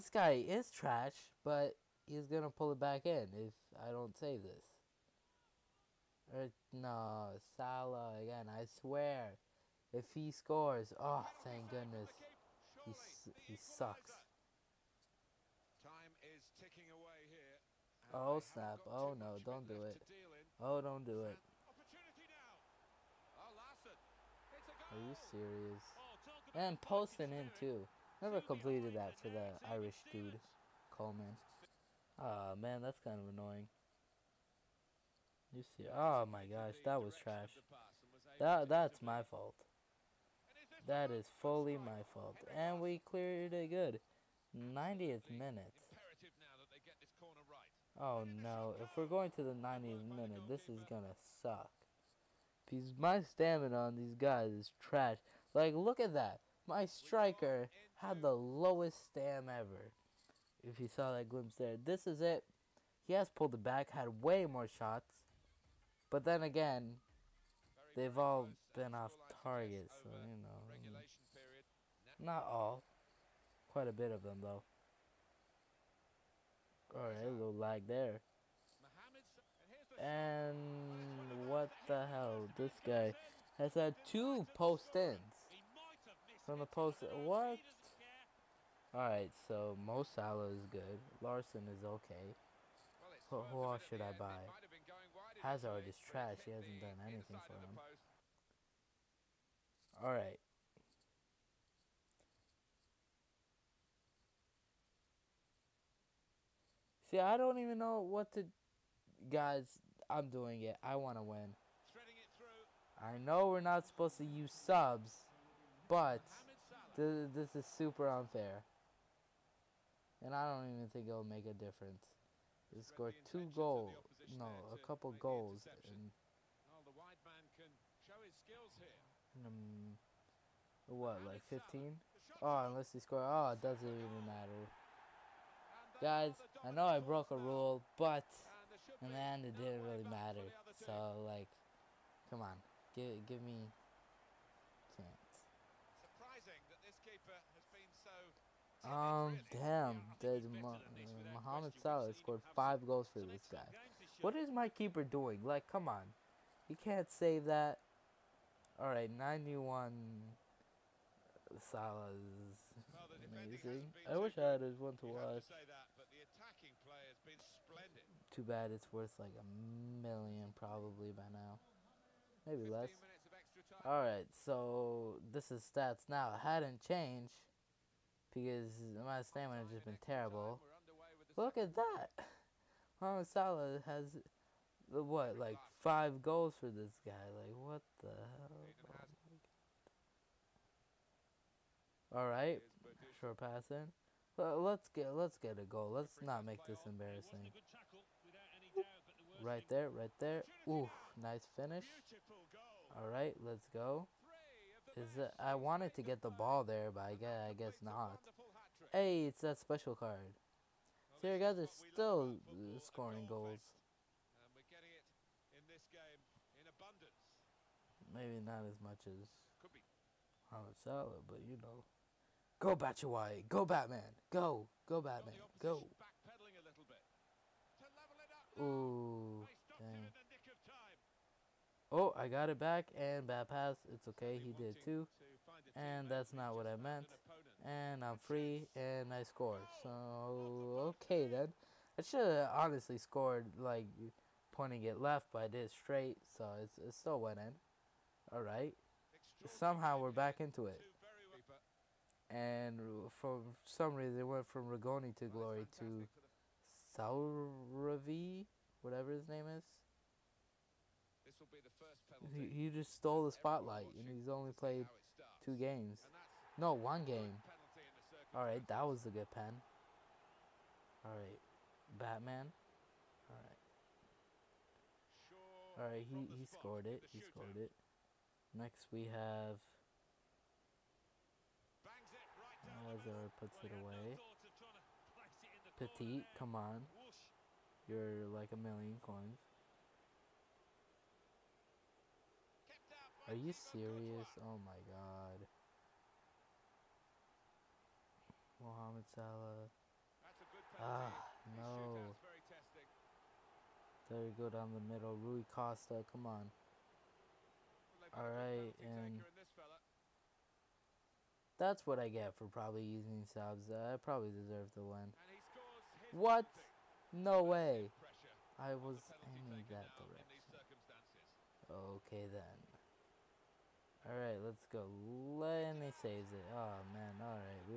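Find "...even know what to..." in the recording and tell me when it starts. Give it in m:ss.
1:47.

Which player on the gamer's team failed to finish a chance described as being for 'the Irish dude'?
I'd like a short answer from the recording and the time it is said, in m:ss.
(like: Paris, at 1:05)
Coleman, at 0:30.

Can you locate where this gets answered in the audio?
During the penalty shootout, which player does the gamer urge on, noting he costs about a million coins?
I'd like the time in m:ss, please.
4:45.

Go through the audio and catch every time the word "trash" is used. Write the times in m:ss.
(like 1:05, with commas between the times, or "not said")
0:00, 0:37, 0:54, 1:35.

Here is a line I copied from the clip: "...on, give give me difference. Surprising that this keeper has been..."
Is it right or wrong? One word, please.
wrong.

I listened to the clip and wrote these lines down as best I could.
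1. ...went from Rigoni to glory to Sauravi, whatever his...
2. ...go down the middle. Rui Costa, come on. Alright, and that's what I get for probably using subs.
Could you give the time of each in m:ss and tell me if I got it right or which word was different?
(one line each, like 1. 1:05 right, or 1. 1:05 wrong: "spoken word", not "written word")
1. 4:14 right
2. 5:04 right.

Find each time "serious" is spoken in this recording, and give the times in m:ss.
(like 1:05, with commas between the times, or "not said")
0:25, 4:53.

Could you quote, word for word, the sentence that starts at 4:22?
He, just stole the spotlight, and he's only played two games.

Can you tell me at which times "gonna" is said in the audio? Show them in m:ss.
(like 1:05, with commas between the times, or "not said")
0:02, 0:50.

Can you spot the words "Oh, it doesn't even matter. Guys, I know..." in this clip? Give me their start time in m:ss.
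2:13.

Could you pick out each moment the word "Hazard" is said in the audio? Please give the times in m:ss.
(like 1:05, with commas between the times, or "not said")
1:35, 4:42.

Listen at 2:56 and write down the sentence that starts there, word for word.
It hadn't changed because my stamina has just been terrible.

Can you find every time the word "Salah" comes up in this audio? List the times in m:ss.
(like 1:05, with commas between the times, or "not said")
0:07, 1:30, 2:31, 2:41, 3:03, 3:40, 4:59.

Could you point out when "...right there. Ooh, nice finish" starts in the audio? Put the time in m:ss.
3:19.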